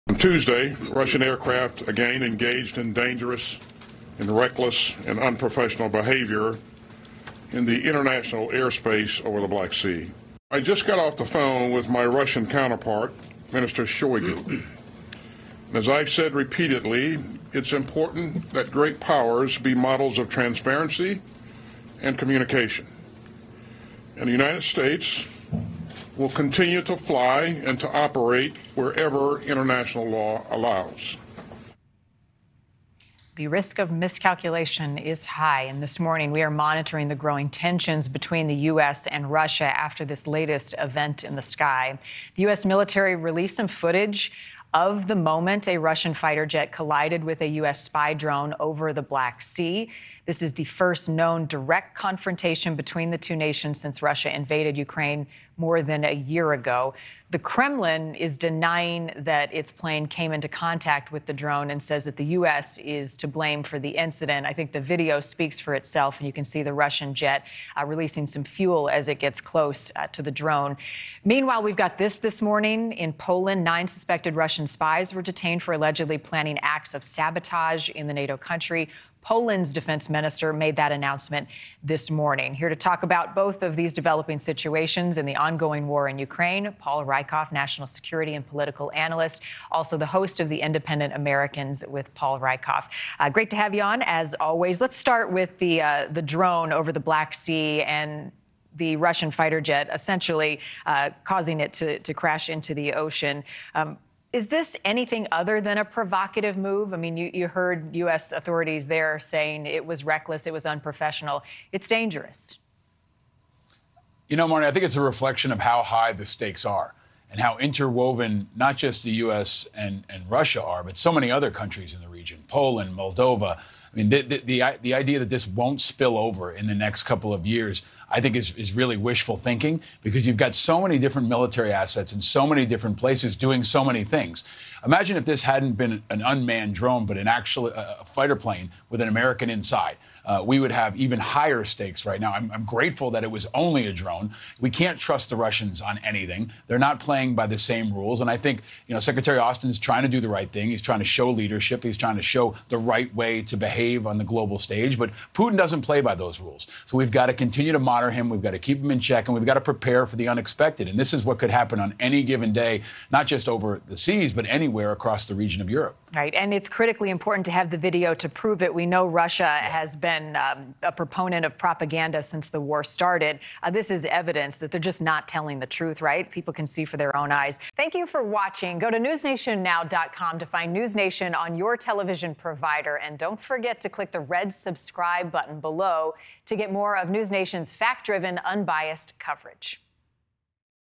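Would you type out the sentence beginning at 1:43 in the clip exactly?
Um, is this anything other than a provocative move?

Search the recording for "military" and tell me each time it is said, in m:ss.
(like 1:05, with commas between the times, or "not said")
0:42, 2:11.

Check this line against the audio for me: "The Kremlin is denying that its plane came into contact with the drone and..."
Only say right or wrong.
right.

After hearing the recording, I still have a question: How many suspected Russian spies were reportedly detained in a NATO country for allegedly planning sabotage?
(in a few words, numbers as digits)
9.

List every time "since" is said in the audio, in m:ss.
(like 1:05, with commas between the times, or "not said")
0:53, 2:52.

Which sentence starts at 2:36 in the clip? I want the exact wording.
So we've got to continue to monitor him.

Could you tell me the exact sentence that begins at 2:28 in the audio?
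And I think, you know, Secretary Austin is trying to do the right thing.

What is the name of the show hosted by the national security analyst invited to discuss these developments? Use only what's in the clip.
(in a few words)
The Independent Americans.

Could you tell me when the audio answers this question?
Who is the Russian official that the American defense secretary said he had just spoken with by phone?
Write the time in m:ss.
0:13.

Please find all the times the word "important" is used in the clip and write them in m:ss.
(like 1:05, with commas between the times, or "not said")
0:17, 2:47.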